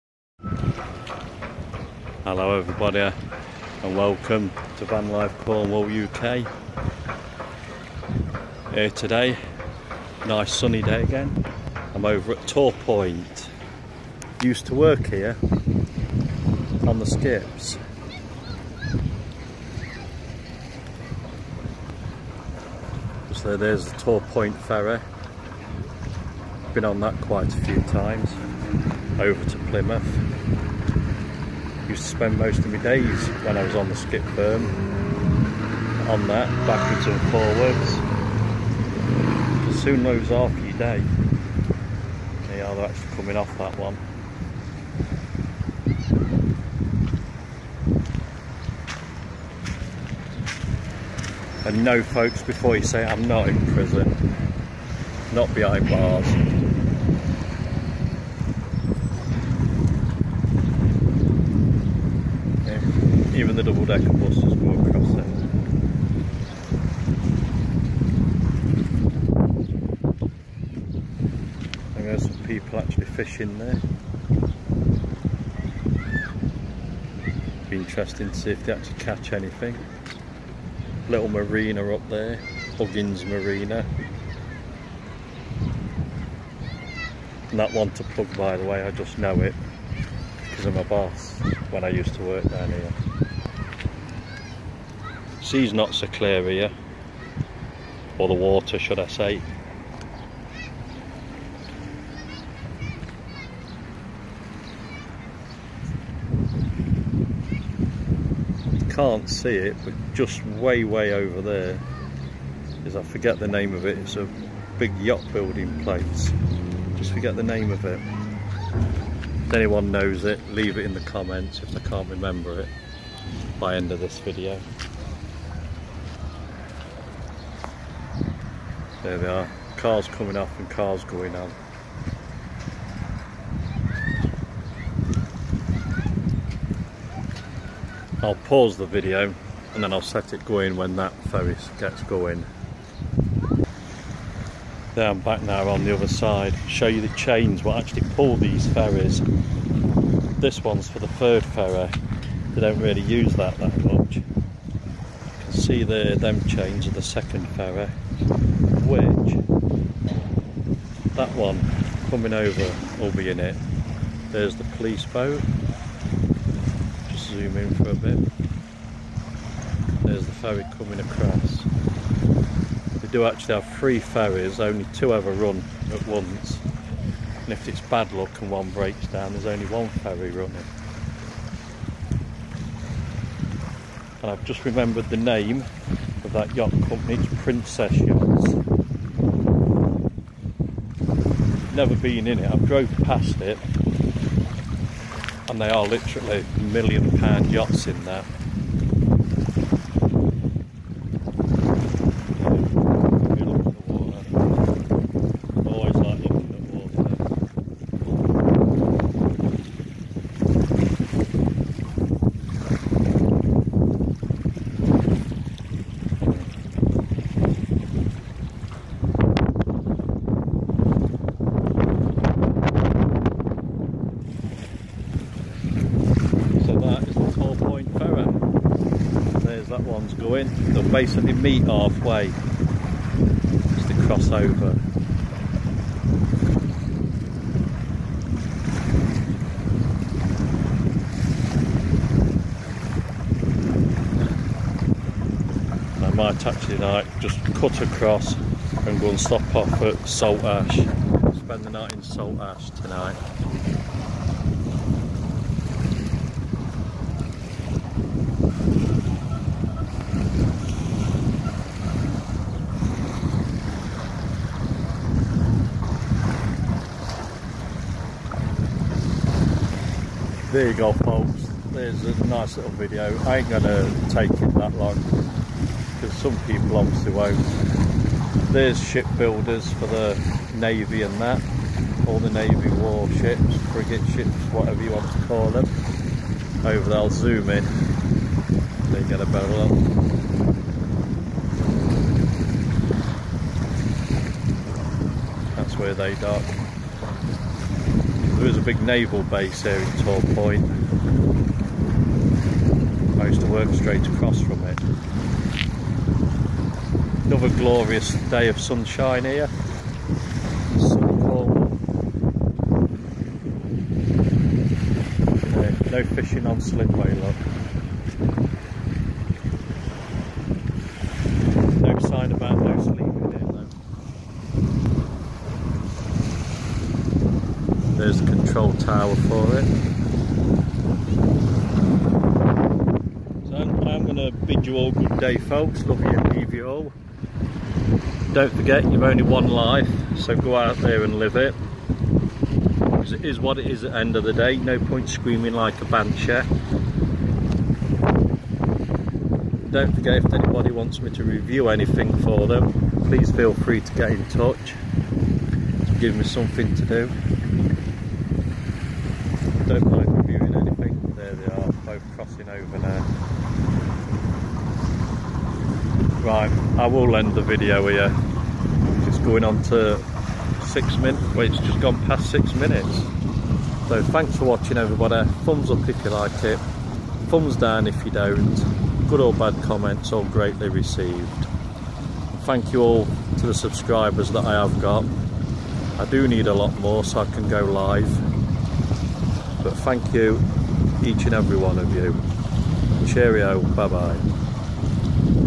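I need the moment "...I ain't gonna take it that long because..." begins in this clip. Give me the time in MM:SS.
04:33.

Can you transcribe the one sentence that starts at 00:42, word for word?
They are actually coming off that one.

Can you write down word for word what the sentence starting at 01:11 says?
And there's some people actually fishing there.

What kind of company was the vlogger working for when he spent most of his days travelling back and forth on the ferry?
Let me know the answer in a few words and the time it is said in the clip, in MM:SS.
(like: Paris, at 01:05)
skip firm, at 00:33.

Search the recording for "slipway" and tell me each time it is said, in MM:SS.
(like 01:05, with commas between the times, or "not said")
05:16.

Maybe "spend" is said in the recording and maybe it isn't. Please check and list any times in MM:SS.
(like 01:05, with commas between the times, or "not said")
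00:32, 04:11.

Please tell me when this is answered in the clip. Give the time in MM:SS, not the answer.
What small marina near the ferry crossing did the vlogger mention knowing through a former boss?
01:22.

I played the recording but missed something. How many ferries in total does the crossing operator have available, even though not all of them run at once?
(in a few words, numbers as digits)
3.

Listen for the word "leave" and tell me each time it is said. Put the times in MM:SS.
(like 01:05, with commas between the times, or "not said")
02:00, 05:36.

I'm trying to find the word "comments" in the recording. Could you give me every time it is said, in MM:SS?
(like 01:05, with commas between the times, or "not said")
02:01, 06:19.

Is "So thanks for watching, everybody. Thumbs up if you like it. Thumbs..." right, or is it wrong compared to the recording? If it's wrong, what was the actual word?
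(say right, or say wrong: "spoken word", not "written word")
right.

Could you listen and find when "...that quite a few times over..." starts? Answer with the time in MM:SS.
00:26.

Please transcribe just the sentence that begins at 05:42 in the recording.
Because it is what it is at the end of the day, no point screaming like a banshee.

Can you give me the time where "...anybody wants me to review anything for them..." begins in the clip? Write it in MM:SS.
05:50.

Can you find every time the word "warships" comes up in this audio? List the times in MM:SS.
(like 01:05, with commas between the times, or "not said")
04:42.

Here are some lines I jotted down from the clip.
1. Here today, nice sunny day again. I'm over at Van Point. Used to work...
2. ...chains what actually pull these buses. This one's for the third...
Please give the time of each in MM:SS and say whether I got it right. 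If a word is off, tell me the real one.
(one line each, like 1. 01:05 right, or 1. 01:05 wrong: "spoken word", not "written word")
1. 00:08 wrong: "Tor", not "Van"
2. 02:27 wrong: "ferries", not "buses".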